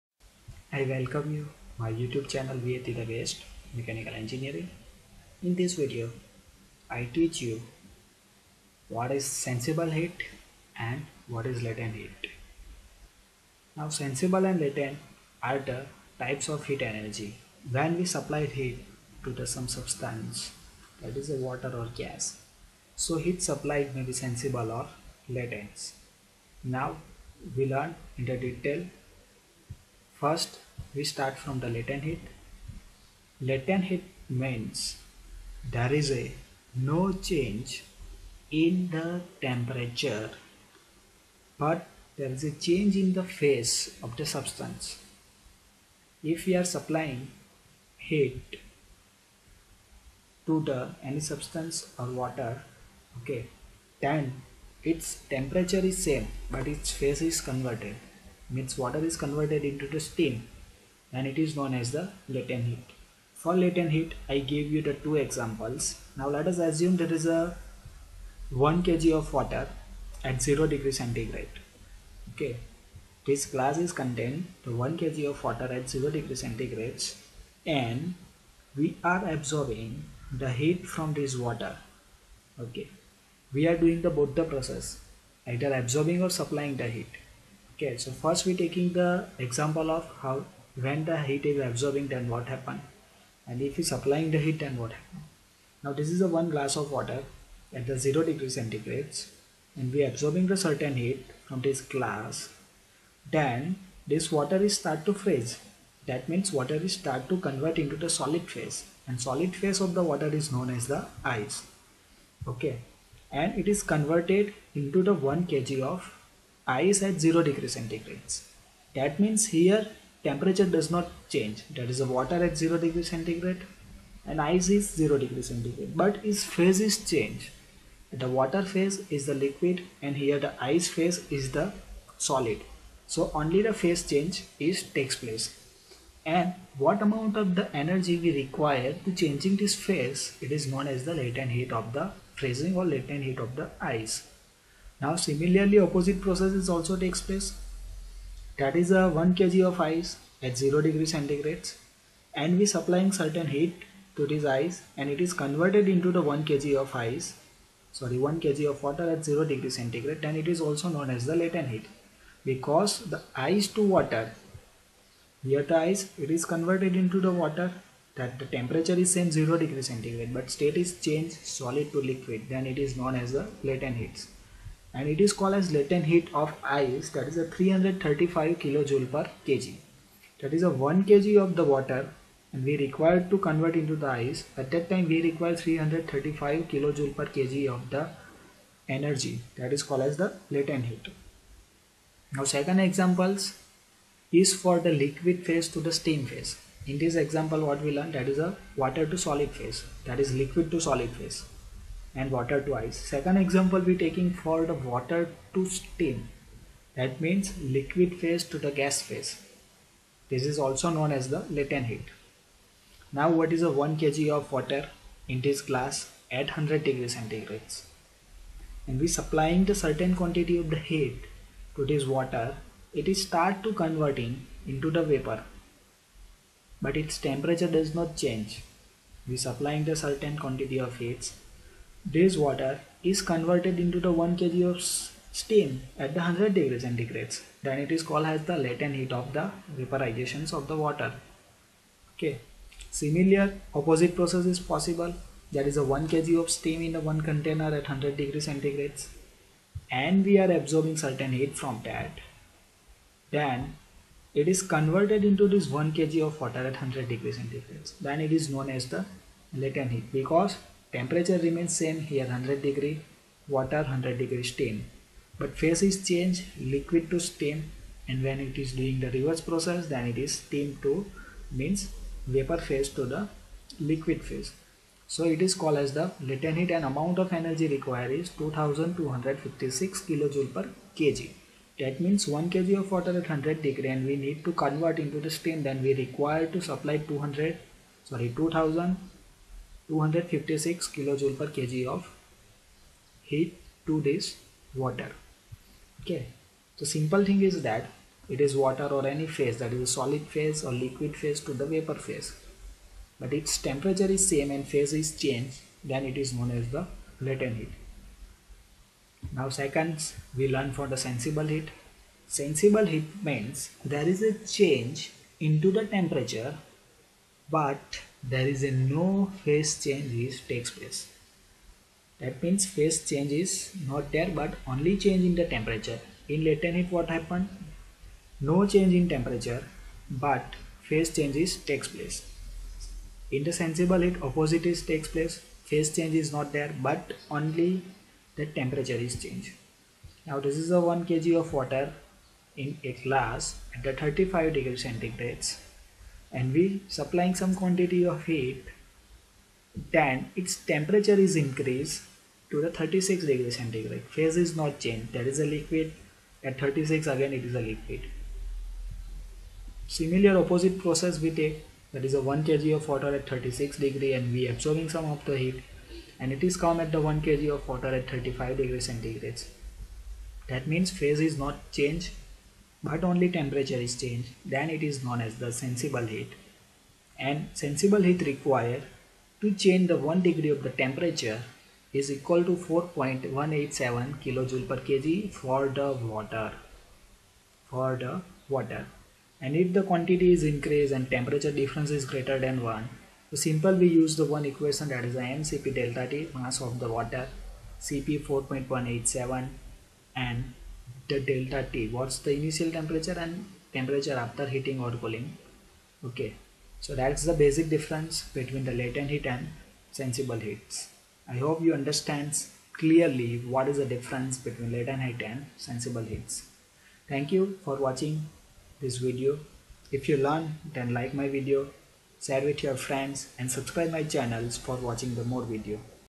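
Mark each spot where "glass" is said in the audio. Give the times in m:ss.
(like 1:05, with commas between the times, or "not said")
1:13, 1:36, 1:41, 3:35, 5:43.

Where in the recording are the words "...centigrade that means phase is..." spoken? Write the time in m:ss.
6:08.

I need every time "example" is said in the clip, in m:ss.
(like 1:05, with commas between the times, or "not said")
1:05, 1:29, 3:12, 3:17, 3:23.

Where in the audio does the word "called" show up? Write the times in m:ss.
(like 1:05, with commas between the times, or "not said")
2:55, 3:09, 3:58, 4:35.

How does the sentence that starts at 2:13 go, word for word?
So only the phase change is takes place.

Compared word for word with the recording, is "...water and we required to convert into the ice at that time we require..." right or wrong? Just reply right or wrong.
right.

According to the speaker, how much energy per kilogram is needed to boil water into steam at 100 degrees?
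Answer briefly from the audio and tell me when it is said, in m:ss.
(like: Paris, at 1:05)
2256 kJ/kg, at 4:38.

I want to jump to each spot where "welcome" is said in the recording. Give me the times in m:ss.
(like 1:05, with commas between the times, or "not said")
0:00.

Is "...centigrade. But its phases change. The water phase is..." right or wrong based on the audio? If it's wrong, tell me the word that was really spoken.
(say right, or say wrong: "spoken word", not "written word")
right.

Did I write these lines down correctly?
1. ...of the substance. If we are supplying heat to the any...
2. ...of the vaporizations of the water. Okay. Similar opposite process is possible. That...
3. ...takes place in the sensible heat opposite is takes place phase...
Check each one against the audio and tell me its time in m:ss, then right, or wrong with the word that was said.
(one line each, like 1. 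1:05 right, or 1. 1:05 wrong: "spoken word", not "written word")
1. 0:44 right
2. 3:59 right
3. 5:31 right.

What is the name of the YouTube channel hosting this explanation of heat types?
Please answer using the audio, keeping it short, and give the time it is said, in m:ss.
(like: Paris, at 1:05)
VAT the Best Mechanical Engineering, at 0:02.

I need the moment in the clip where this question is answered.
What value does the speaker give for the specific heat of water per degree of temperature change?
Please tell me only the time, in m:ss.
6:22.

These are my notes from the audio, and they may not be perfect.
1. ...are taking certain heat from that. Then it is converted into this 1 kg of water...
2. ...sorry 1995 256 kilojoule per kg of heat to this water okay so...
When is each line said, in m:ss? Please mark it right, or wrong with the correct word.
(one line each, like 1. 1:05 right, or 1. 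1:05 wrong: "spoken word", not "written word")
1. 4:10 wrong: "absorbing", not "taking"
2. 4:48 wrong: "2000", not "1995".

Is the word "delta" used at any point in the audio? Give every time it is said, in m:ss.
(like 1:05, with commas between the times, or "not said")
6:35, 6:41.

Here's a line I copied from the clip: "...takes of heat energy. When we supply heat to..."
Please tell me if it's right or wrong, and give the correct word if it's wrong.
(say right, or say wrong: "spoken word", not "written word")
wrong: "types", not "takes".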